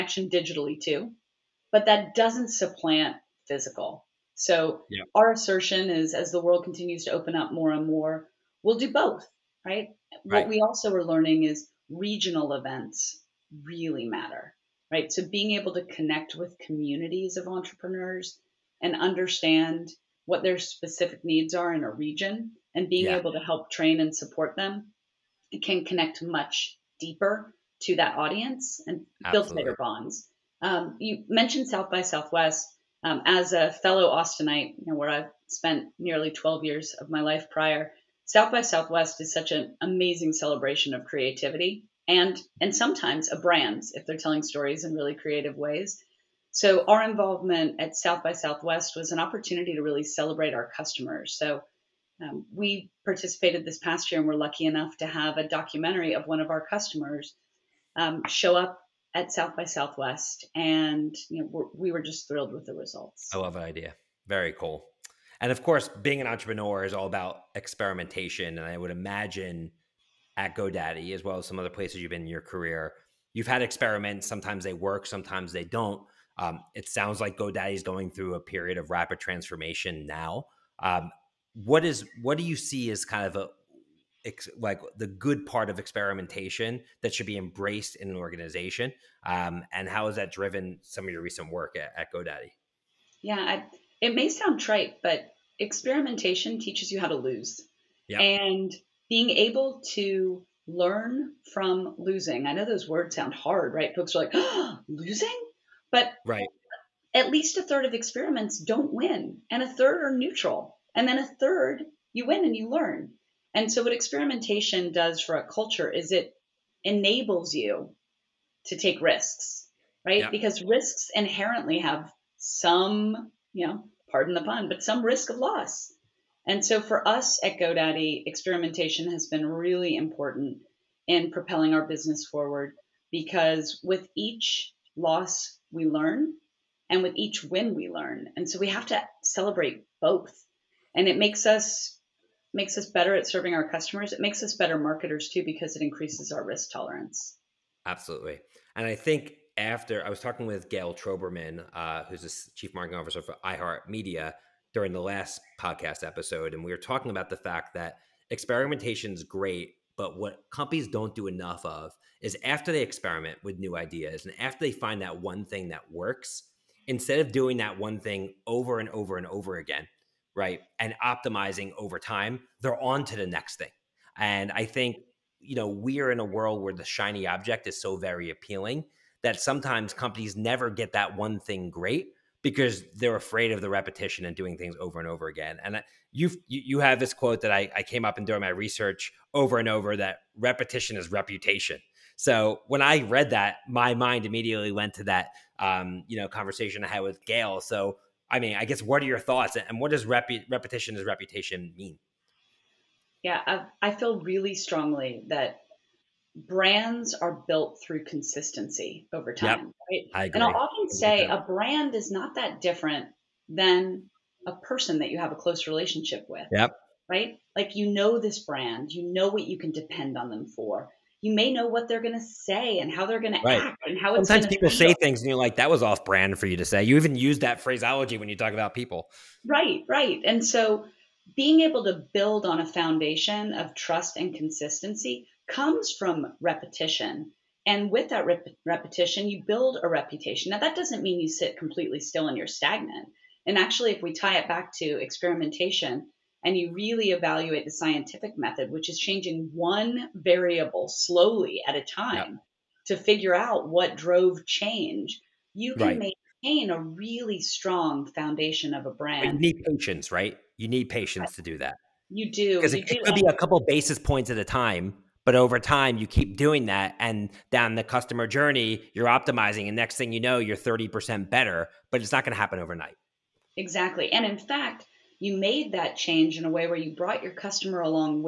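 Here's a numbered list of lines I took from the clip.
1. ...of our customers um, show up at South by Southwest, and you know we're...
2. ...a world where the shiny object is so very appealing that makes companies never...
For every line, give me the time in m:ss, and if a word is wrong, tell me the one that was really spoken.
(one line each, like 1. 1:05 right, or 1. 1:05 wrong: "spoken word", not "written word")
1. 0:56 right
2. 2:56 wrong: "sometimes", not "makes".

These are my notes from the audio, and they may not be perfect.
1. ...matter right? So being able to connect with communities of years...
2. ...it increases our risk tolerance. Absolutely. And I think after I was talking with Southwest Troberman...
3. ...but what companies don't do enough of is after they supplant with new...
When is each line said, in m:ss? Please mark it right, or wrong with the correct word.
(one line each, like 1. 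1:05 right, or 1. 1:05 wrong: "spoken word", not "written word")
1. 0:14 wrong: "entrepreneurs", not "years"
2. 2:25 wrong: "Gayle", not "Southwest"
3. 2:39 wrong: "experiment", not "supplant".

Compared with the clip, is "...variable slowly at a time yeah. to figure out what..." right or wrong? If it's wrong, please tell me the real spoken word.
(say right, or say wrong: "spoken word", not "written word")
right.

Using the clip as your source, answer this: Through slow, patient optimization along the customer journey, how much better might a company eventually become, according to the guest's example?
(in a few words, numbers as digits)
30%.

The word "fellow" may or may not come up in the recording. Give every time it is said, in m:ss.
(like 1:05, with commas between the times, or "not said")
0:33.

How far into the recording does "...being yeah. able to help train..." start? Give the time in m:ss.
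0:22.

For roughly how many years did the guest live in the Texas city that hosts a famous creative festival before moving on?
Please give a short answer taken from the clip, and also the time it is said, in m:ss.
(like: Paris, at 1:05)
12 years, at 0:35.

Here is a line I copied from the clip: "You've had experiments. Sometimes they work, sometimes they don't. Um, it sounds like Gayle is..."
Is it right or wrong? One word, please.
wrong.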